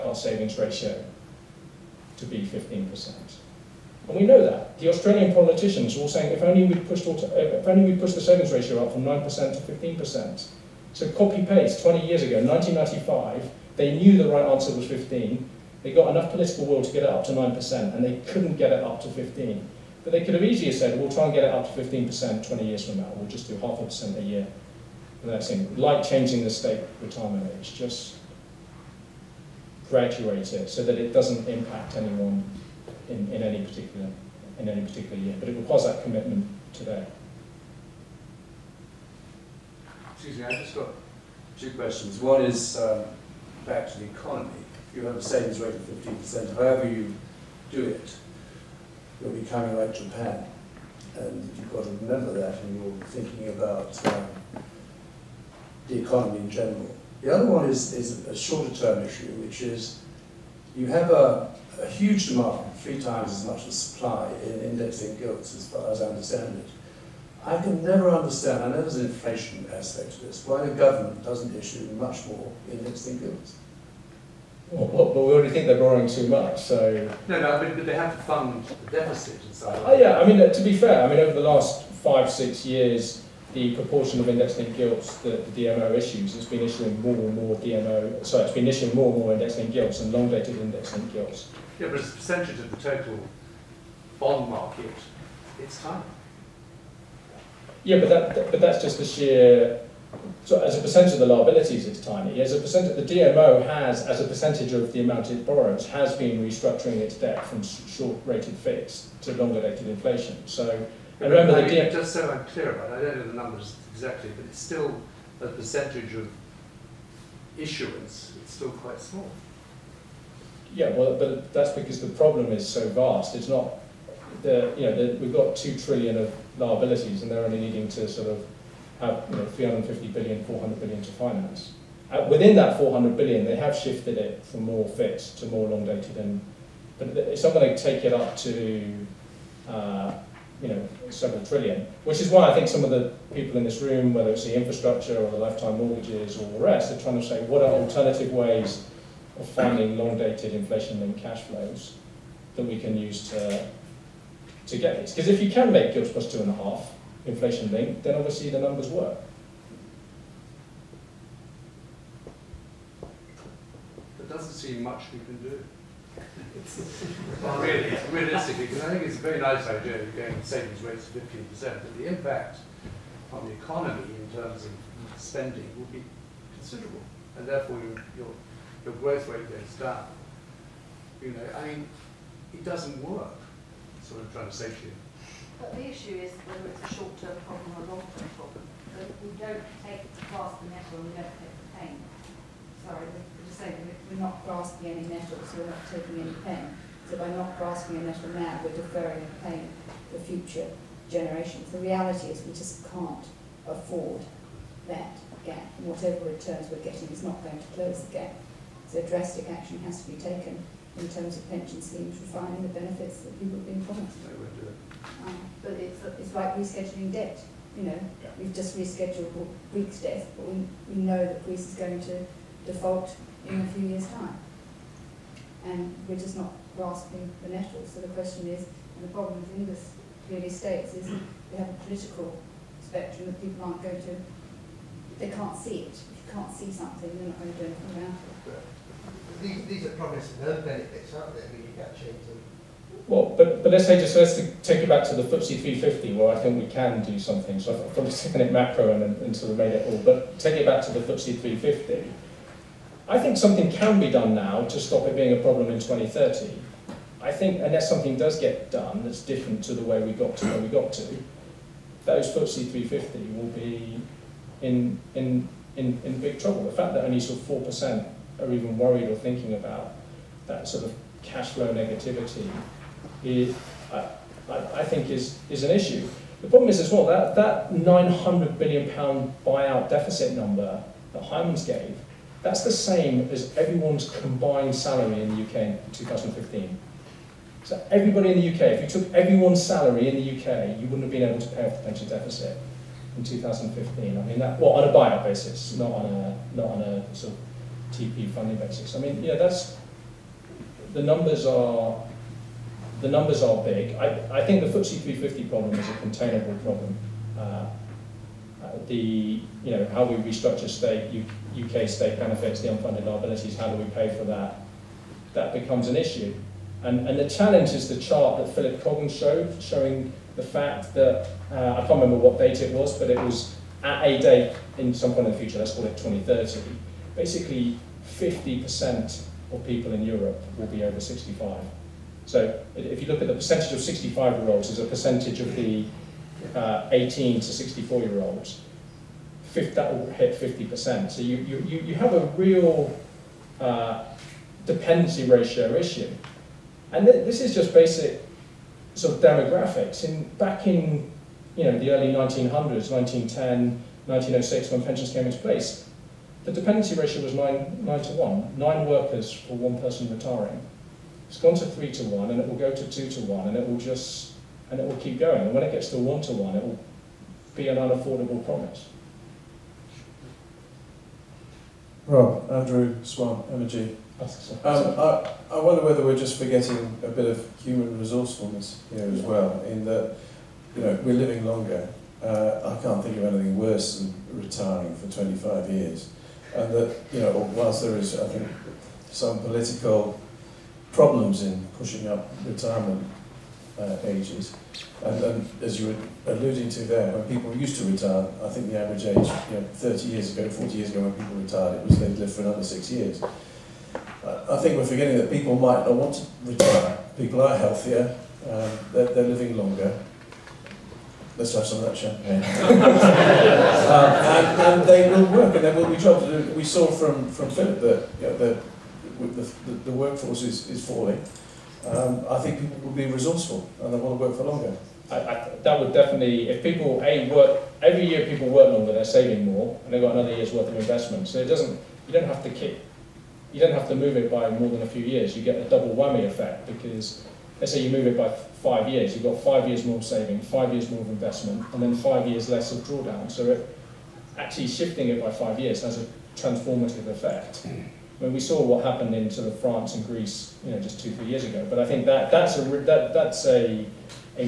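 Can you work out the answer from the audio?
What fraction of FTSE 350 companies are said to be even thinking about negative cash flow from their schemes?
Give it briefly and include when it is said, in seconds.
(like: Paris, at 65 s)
4%, at 267 s.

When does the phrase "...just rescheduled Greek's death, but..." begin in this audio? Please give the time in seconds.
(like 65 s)
218 s.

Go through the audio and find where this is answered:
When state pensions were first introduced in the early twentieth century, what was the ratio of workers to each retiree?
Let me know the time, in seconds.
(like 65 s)
357 s.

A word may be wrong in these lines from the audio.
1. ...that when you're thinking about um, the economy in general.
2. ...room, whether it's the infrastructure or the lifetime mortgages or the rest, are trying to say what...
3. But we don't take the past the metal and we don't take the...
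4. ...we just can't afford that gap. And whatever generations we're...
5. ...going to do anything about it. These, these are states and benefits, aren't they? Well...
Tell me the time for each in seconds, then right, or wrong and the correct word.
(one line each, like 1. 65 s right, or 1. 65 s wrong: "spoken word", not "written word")
1. 52 s right
2. 143 s right
3. 188 s right
4. 202 s wrong: "returns", not "generations"
5. 237 s wrong: "promises", not "states".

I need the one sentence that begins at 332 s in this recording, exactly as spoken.
So if you look at the percentage of 65-year-olds as a percentage of the uh, 18 to 64-year-olds, that will hit 50%.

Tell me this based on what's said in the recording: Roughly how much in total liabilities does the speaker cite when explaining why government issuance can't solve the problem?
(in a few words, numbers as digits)
two trillion.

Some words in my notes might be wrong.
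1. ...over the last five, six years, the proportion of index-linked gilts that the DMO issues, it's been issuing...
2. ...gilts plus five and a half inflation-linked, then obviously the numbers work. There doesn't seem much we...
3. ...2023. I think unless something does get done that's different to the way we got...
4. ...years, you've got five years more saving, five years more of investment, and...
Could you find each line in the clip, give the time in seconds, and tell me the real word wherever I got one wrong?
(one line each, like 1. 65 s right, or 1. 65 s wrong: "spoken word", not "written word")
1. 81 s right
2. 155 s wrong: "two", not "five"
3. 255 s wrong: "2030", not "2023"
4. 438 s right.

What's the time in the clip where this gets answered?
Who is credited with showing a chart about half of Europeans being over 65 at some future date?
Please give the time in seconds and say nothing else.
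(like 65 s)
318 s.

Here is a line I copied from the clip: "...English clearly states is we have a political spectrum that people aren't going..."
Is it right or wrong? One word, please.
right.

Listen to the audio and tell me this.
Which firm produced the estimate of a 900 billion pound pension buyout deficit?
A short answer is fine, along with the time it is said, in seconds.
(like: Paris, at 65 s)
Hymans, at 281 s.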